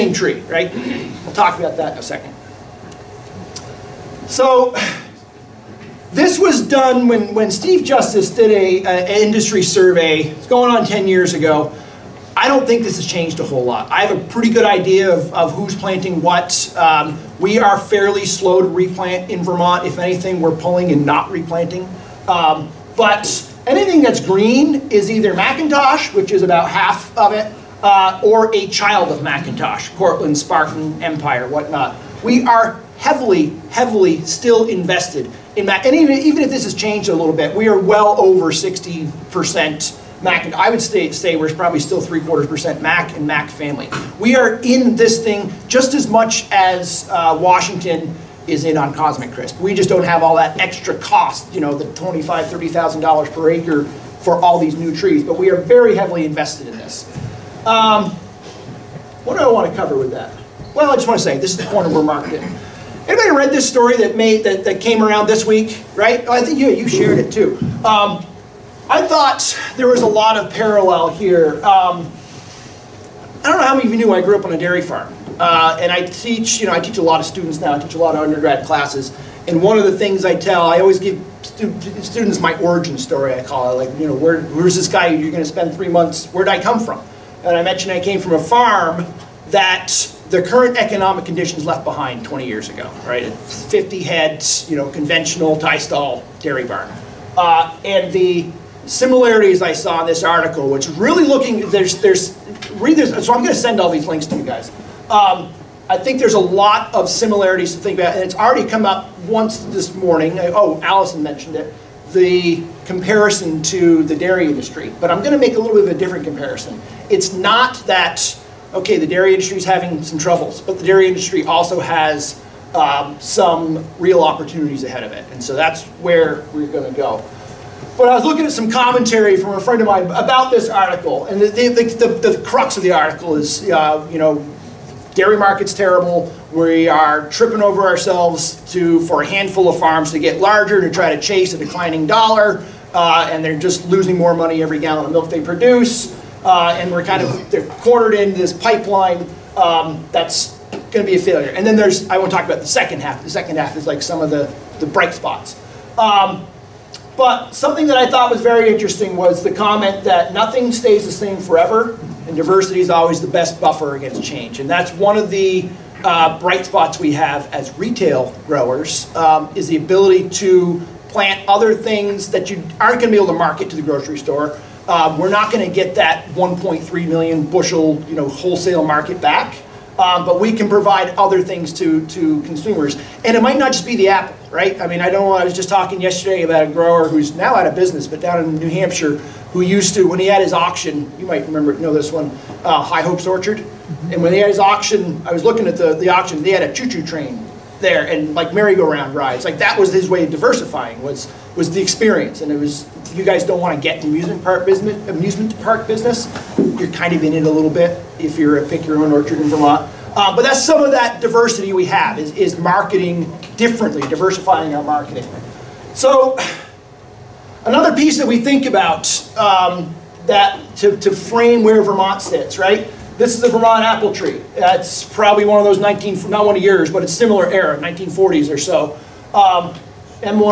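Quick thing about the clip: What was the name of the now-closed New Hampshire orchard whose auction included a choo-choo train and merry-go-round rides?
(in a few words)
High Hopes Orchard.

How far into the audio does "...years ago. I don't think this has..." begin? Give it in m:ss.
0:11.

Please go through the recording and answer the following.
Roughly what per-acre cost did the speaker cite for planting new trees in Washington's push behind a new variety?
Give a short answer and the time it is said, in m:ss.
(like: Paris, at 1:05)
$25,000 to $30,000, at 0:51.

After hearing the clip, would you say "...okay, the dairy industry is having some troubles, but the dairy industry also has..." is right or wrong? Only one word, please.
right.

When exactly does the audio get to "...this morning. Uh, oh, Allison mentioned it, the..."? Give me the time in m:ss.
1:49.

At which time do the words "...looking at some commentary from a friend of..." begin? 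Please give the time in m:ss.
2:08.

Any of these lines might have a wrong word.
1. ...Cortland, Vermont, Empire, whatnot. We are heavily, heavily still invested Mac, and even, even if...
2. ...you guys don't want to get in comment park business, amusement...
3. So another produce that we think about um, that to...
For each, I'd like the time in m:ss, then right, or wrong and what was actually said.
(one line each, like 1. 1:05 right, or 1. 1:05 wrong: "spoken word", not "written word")
1. 0:29 wrong: "Spartan", not "Vermont"
2. 3:23 wrong: "amusement", not "comment"
3. 3:35 wrong: "piece", not "produce".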